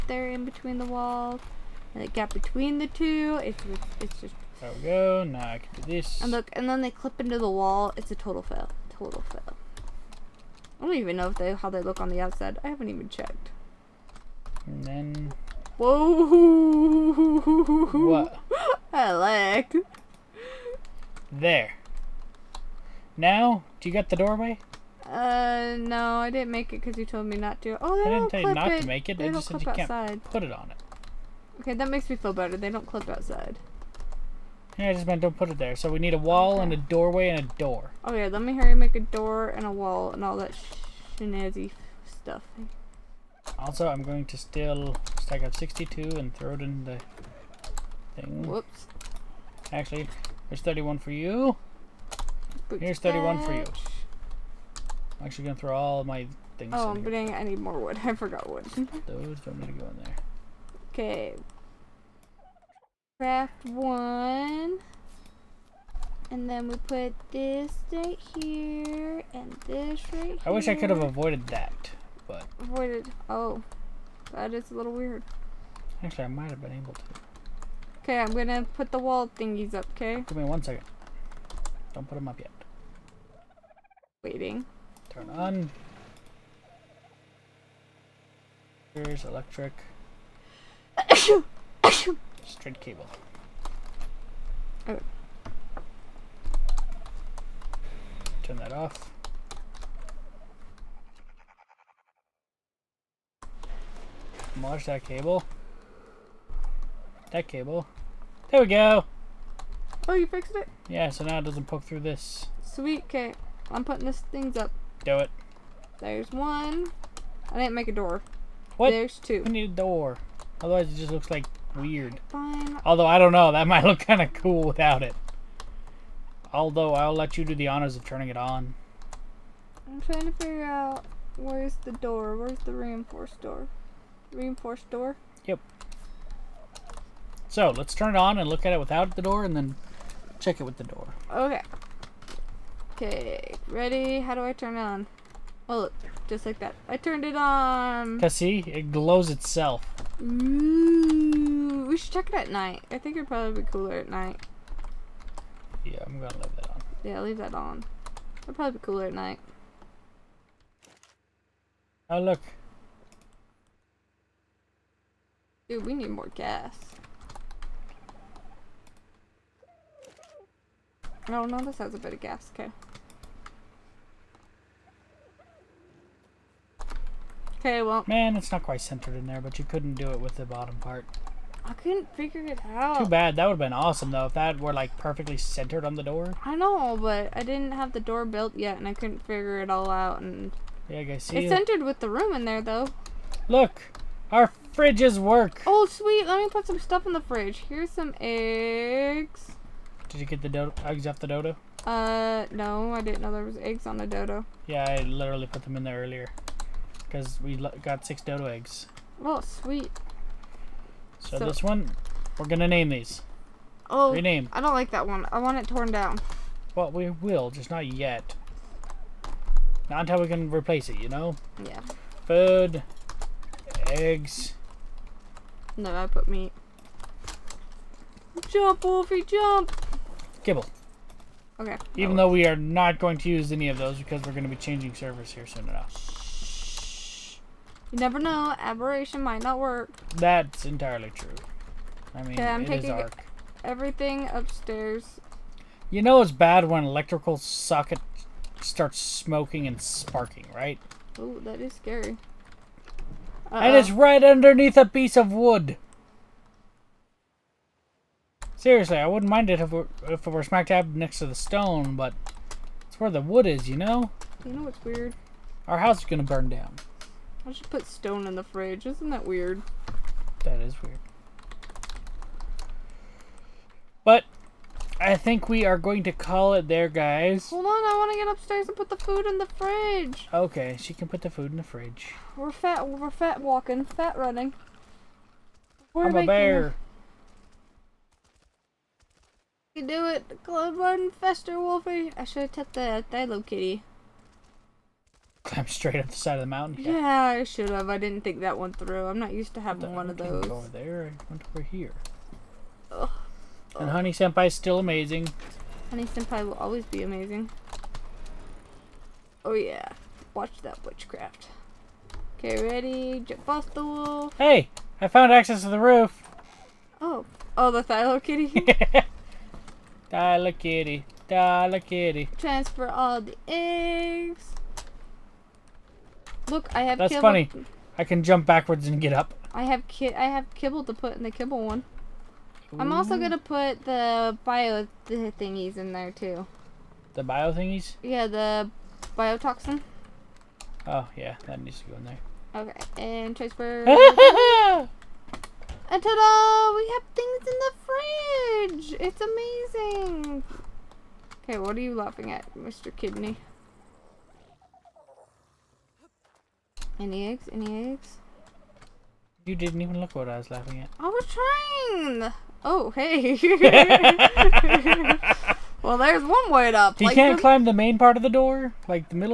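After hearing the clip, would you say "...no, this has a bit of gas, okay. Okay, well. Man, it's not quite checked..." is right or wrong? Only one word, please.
wrong.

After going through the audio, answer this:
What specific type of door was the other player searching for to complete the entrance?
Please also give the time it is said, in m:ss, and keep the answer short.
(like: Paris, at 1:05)
Reinforced door, at 2:12.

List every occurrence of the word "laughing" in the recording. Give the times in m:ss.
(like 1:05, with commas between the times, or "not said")
5:51, 6:00.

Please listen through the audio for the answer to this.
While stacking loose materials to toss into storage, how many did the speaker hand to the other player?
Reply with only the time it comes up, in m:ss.
0:52.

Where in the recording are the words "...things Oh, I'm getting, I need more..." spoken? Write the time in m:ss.
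0:56.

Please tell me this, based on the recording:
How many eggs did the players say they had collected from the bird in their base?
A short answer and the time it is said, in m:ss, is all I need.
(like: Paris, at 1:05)
Six, at 3:27.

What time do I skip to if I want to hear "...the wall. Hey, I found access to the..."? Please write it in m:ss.
5:13.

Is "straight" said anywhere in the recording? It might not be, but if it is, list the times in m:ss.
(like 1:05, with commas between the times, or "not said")
1:32, 4:55.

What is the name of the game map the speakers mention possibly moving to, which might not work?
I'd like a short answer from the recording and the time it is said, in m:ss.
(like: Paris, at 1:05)
Aberration, at 3:58.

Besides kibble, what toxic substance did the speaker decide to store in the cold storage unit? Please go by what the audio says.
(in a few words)
Biotoxin.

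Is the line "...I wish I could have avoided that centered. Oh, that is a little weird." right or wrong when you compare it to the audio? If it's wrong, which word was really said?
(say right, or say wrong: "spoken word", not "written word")
wrong: "avoided", not "centered".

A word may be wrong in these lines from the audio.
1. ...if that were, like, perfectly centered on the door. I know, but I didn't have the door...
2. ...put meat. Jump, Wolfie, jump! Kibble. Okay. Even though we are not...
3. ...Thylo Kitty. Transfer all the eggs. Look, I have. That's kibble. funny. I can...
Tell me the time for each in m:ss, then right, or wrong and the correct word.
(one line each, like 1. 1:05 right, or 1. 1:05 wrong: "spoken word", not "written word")
1. 3:04 right
2. 3:46 right
3. 5:21 right.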